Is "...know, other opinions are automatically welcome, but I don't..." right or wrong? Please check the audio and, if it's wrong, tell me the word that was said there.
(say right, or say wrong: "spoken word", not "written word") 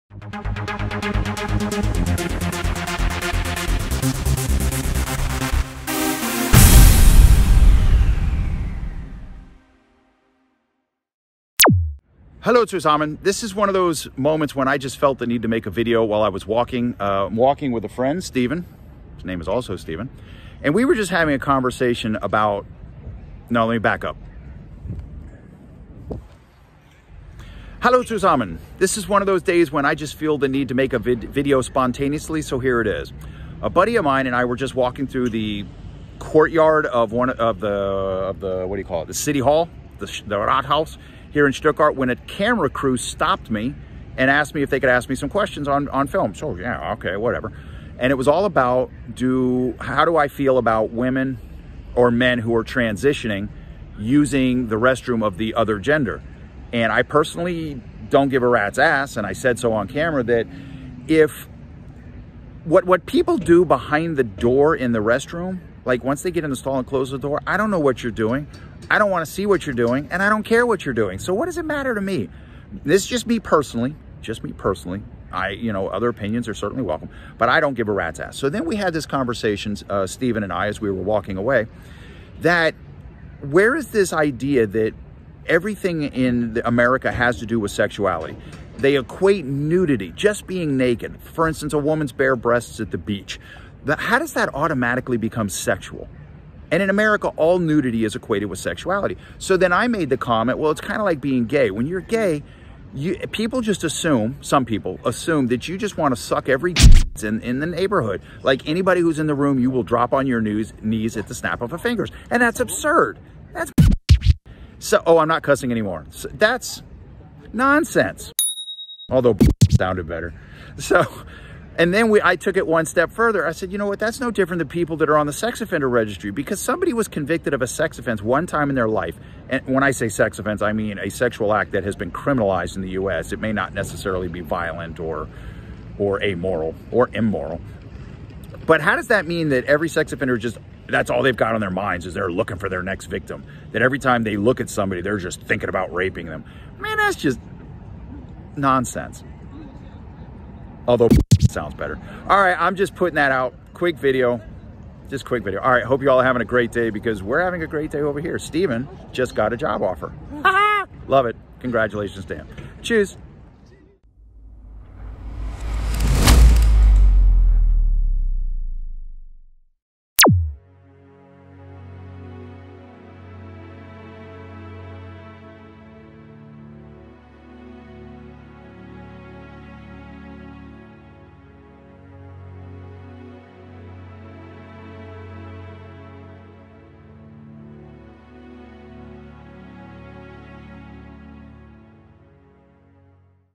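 wrong: "certainly", not "automatically".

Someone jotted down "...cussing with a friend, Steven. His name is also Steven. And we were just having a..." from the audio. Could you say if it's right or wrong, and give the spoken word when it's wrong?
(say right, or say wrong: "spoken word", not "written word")
wrong: "walking", not "cussing".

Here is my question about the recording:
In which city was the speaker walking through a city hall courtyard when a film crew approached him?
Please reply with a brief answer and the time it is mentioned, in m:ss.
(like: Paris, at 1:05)
Stuttgart, at 0:41.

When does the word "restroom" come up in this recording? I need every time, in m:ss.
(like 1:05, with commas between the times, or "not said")
0:54, 1:04.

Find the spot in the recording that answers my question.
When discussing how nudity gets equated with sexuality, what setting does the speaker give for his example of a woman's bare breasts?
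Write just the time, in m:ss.
1:32.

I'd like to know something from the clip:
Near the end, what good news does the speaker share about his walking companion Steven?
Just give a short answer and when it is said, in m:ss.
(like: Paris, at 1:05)
a job offer, at 2:39.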